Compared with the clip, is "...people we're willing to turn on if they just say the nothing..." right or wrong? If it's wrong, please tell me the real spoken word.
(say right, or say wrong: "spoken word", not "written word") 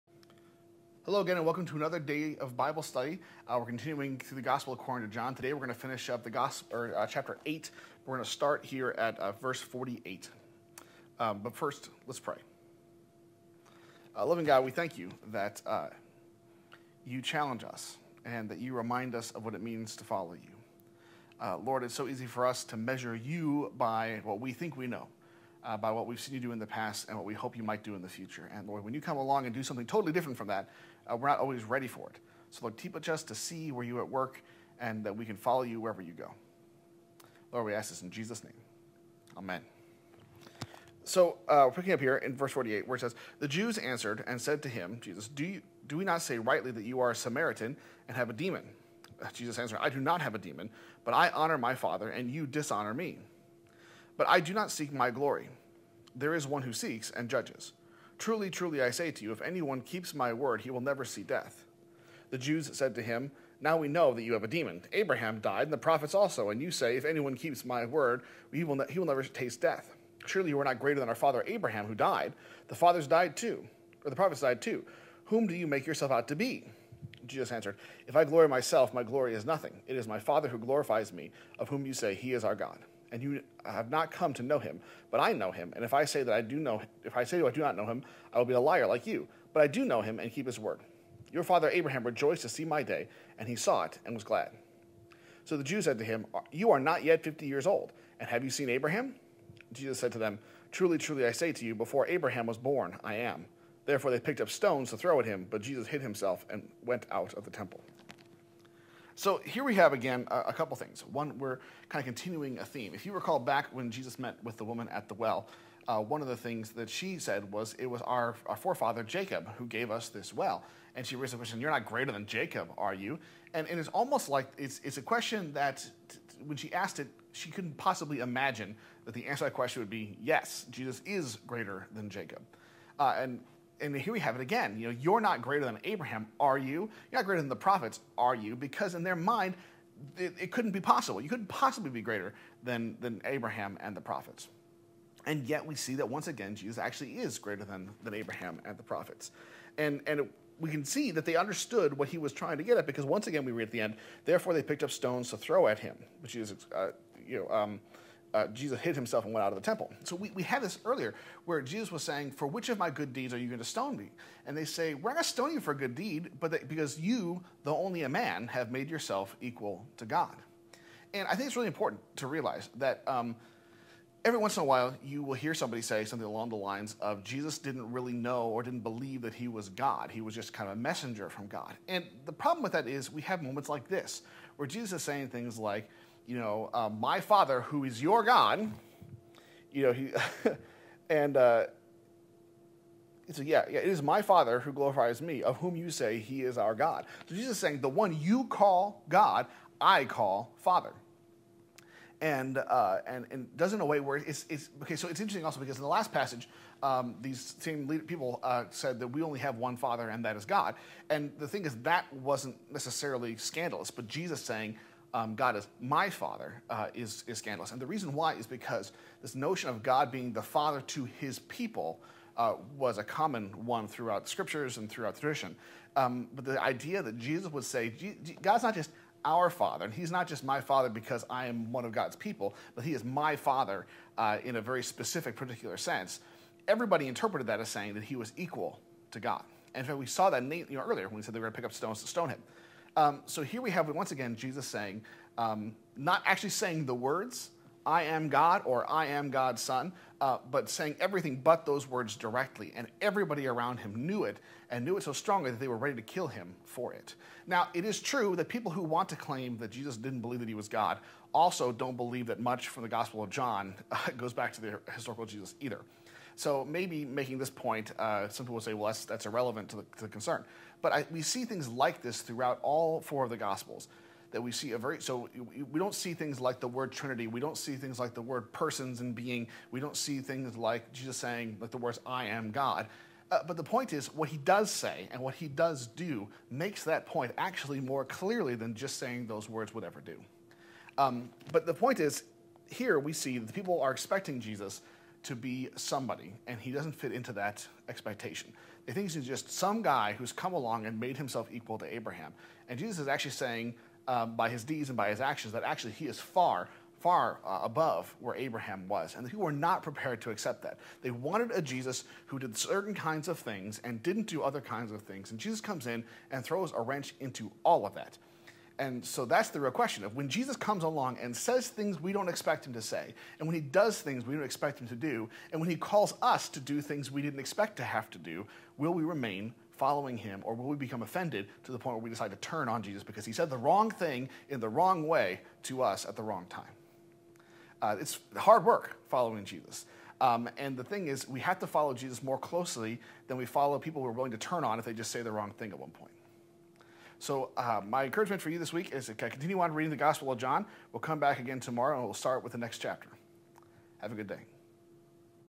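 wrong: "wrong", not "nothing".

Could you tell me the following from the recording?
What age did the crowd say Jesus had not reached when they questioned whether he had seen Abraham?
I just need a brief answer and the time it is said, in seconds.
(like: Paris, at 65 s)
50, at 97 s.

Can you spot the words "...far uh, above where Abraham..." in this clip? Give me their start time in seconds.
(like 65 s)
306 s.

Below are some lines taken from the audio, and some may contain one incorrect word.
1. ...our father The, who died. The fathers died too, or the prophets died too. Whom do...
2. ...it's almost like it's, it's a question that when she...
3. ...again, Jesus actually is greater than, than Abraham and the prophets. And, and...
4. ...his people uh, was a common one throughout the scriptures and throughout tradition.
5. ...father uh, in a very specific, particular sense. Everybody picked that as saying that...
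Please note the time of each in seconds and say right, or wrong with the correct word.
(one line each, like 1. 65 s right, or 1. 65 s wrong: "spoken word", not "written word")
1. 71 s wrong: "Abraham", not "The"
2. 123 s right
3. 146 s right
4. 221 s right
5. 233 s wrong: "interpreted", not "picked".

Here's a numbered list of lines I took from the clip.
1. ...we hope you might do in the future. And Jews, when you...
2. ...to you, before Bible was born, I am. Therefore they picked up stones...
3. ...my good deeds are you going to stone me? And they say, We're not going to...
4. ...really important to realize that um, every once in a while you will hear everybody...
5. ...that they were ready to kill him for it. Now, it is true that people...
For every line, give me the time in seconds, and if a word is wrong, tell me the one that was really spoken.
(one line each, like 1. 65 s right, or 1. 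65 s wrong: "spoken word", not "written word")
1. 27 s wrong: "Lord", not "Jews"
2. 101 s wrong: "Abraham", not "Bible"
3. 162 s right
4. 171 s wrong: "somebody", not "everybody"
5. 255 s right.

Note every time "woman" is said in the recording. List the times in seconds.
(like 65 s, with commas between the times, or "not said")
114 s.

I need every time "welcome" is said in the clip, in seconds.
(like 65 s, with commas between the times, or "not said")
1 s.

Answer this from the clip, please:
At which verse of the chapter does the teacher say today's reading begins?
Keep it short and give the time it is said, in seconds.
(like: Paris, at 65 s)
48, at 9 s.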